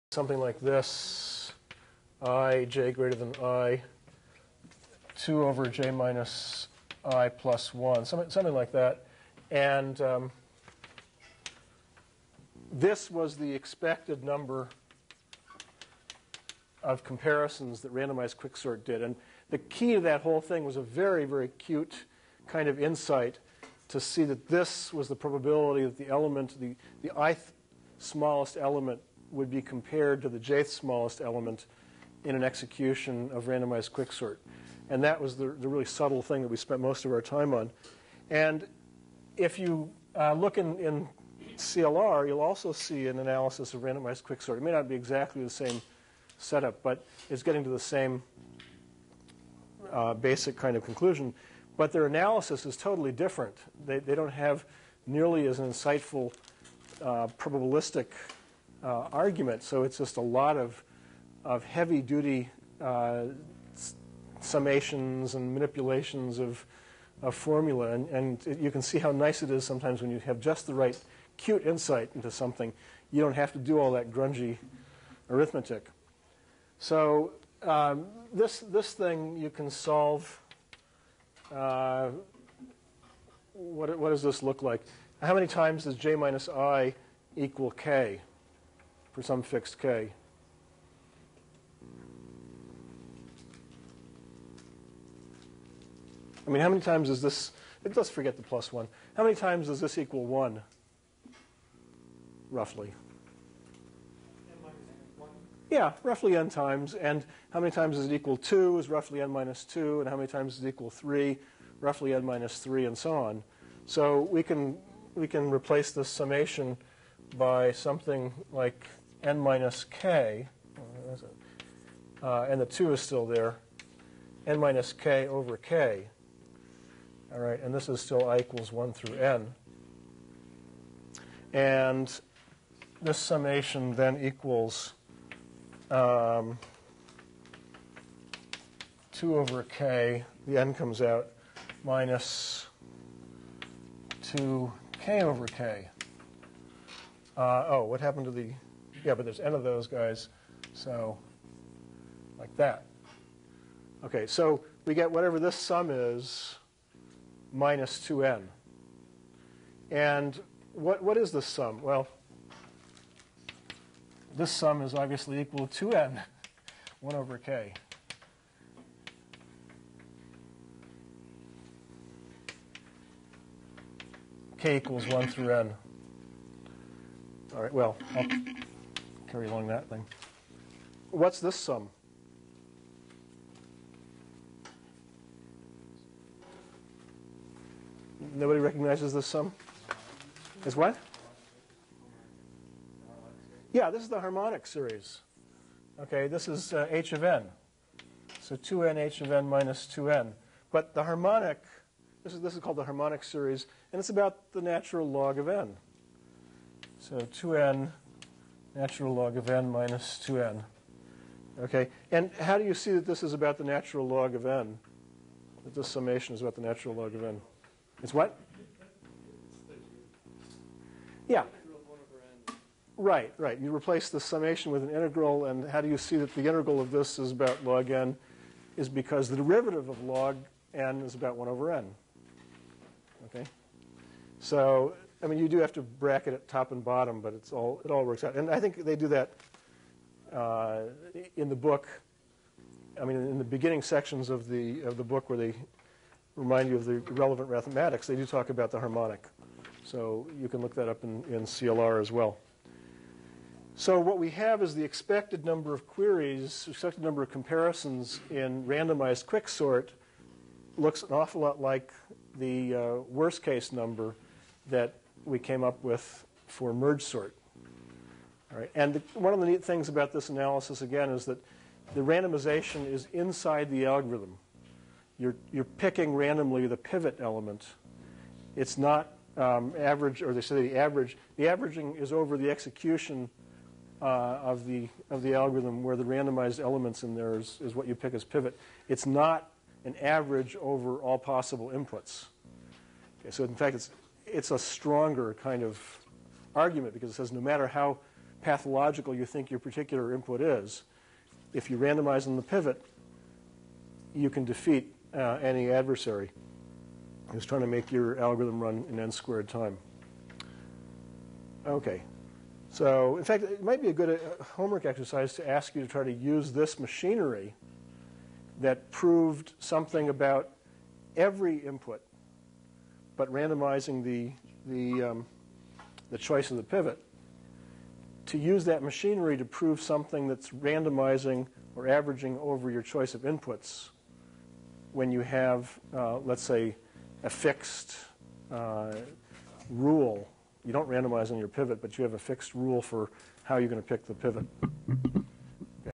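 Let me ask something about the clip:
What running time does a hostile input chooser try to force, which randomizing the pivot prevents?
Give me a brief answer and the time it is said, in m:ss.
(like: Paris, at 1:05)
n squared, at 5:08.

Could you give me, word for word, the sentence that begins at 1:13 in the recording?
You don't have to do all that grungy arithmetic.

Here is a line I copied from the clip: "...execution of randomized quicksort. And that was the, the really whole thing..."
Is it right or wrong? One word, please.
wrong.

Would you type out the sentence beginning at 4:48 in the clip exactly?
It's not an average over all possible inputs.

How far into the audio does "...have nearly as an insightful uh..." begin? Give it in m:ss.
0:54.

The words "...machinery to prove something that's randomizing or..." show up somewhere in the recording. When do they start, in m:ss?
5:28.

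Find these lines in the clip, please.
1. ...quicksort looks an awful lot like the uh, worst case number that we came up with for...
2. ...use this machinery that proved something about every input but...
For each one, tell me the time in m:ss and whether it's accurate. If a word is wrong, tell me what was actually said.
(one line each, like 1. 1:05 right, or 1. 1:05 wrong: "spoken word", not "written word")
1. 4:19 right
2. 5:16 right.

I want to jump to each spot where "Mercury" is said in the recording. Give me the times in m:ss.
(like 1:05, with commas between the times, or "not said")
not said.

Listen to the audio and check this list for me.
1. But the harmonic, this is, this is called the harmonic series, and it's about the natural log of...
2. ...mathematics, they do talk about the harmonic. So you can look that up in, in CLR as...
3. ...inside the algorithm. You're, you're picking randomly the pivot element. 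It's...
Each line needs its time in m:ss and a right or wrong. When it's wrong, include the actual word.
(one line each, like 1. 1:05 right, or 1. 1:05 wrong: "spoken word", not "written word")
1. 3:20 right
2. 4:07 right
3. 4:33 right.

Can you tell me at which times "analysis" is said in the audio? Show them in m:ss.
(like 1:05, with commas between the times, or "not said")
0:43, 0:52, 4:30.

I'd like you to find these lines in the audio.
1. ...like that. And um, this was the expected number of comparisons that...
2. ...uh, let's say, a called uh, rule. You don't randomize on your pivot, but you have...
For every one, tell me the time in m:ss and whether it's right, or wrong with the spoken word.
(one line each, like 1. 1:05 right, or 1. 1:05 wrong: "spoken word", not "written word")
1. 0:08 right
2. 5:35 wrong: "fixed", not "called".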